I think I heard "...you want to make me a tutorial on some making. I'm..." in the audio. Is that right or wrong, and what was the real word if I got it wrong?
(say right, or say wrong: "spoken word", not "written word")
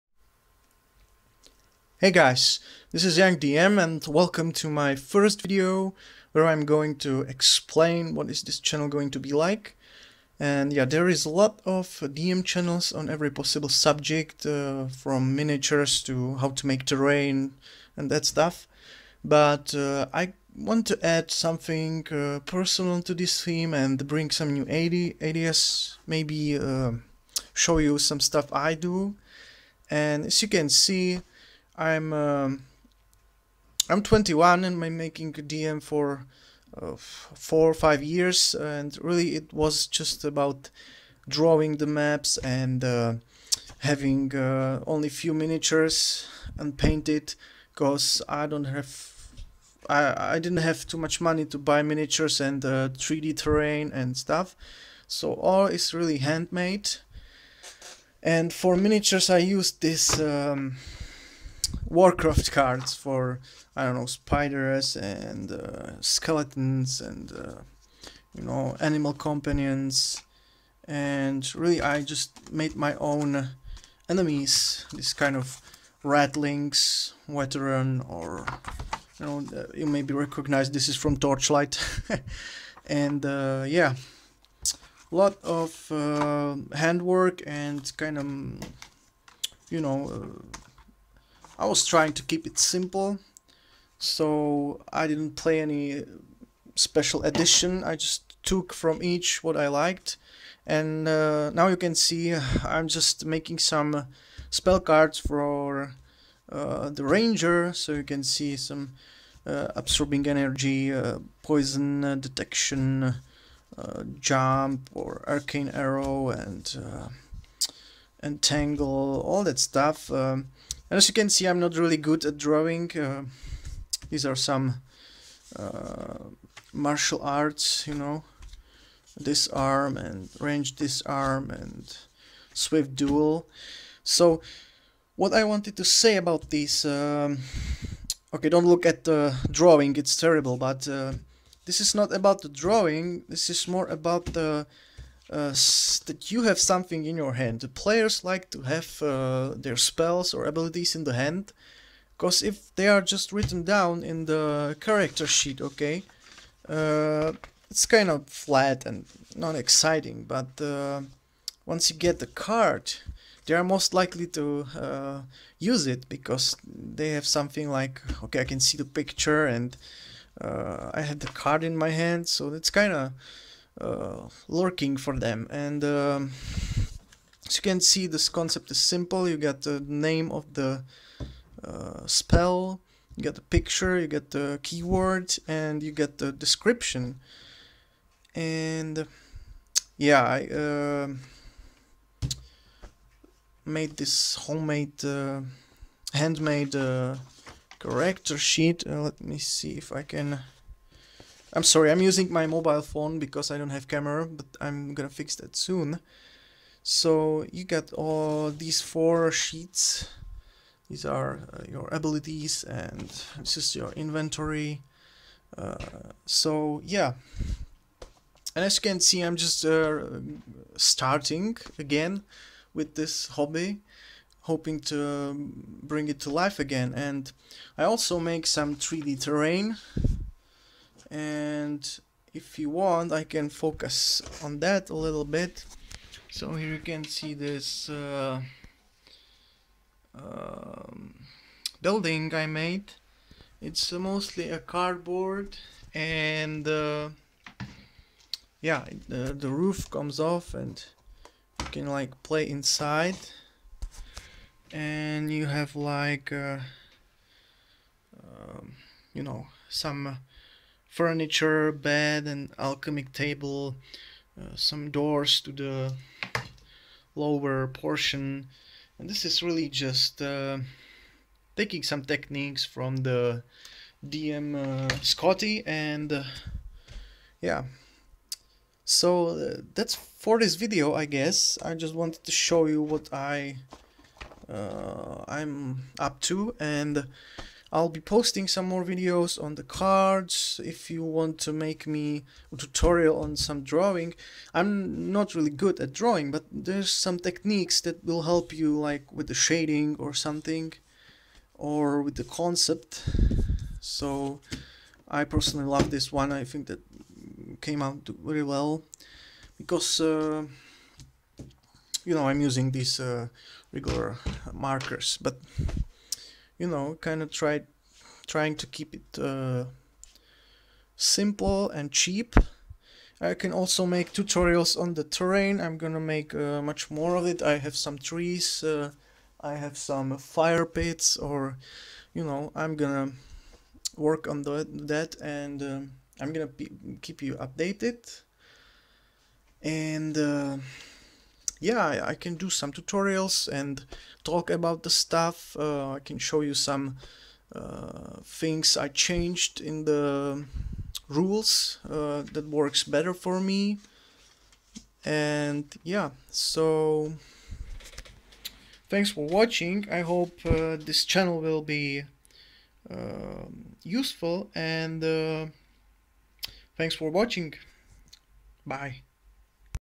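wrong: "drawing", not "making".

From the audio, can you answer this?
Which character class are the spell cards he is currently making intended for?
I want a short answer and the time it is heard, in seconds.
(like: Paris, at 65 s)
Ranger, at 106 s.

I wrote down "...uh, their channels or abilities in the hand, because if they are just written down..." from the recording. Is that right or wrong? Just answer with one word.
wrong.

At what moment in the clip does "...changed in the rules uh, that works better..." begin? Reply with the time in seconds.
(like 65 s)
348 s.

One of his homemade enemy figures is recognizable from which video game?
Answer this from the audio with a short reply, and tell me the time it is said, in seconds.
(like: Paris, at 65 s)
Torchlight, at 81 s.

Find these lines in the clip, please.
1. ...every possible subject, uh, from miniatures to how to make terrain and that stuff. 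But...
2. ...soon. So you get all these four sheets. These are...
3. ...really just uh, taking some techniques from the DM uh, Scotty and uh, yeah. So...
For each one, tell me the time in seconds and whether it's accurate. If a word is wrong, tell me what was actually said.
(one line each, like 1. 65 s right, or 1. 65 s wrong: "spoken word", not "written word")
1. 13 s right
2. 205 s right
3. 269 s right.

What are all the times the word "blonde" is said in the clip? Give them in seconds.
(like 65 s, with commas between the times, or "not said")
not said.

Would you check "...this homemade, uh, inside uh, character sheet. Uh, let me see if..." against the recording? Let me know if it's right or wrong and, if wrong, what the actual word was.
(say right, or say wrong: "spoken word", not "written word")
wrong: "handmade", not "inside".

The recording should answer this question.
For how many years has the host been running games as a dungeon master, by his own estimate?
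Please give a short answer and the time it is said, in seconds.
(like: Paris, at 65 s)
4 or 5, at 36 s.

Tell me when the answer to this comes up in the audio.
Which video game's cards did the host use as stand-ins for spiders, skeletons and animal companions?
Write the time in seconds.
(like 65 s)
61 s.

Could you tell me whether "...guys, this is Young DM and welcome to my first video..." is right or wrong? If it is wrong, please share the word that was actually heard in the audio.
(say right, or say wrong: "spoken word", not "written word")
right.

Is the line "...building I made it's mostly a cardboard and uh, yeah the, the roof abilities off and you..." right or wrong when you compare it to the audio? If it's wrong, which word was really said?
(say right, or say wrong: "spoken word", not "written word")
wrong: "comes", not "abilities".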